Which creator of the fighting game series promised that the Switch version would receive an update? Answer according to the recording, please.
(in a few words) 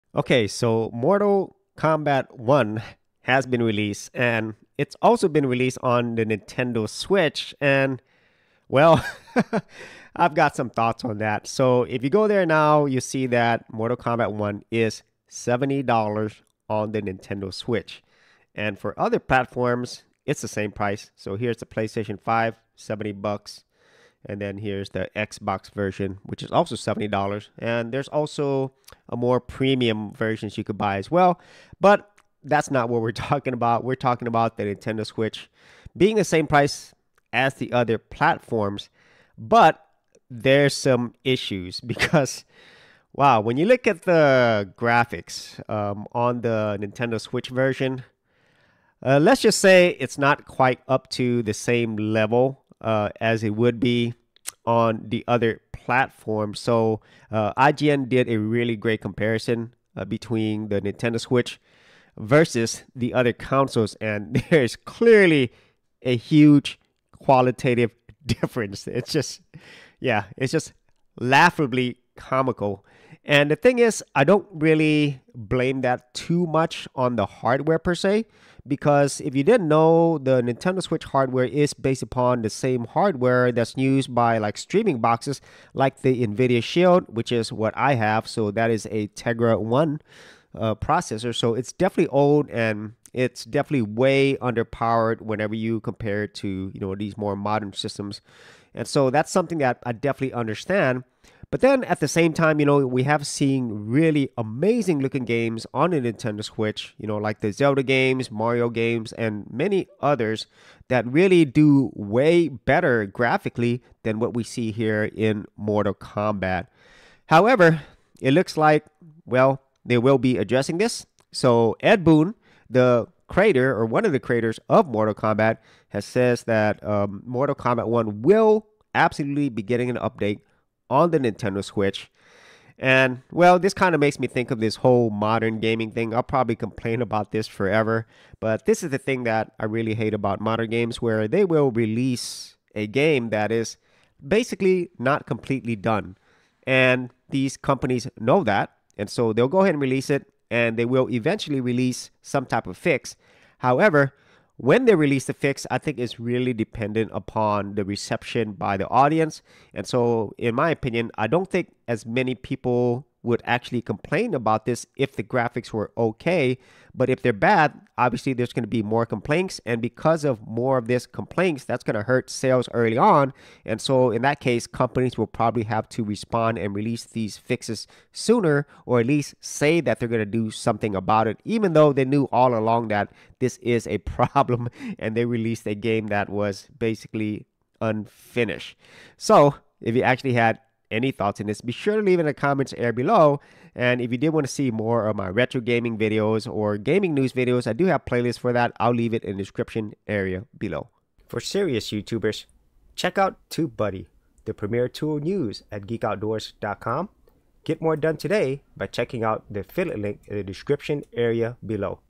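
Ed Boon.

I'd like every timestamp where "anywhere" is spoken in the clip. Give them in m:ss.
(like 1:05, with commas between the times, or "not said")
not said.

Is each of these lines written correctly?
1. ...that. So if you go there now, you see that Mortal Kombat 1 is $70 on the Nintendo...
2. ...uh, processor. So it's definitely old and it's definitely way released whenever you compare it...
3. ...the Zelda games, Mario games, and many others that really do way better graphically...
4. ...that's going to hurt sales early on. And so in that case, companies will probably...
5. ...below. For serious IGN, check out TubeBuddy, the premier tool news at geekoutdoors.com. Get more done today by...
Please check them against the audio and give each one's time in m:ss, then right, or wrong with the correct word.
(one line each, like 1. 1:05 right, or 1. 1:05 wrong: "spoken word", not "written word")
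1. 0:11 right
2. 1:30 wrong: "underpowered", not "released"
3. 1:47 right
4. 2:51 right
5. 3:20 wrong: "YouTubers", not "IGN".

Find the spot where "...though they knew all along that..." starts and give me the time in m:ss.
3:01.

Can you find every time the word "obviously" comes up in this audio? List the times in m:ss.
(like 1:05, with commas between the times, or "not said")
2:47.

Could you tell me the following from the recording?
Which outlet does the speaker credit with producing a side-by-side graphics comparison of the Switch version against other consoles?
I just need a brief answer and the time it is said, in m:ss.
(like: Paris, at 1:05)
IGN, at 0:57.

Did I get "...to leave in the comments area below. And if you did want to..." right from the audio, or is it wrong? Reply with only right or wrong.
right.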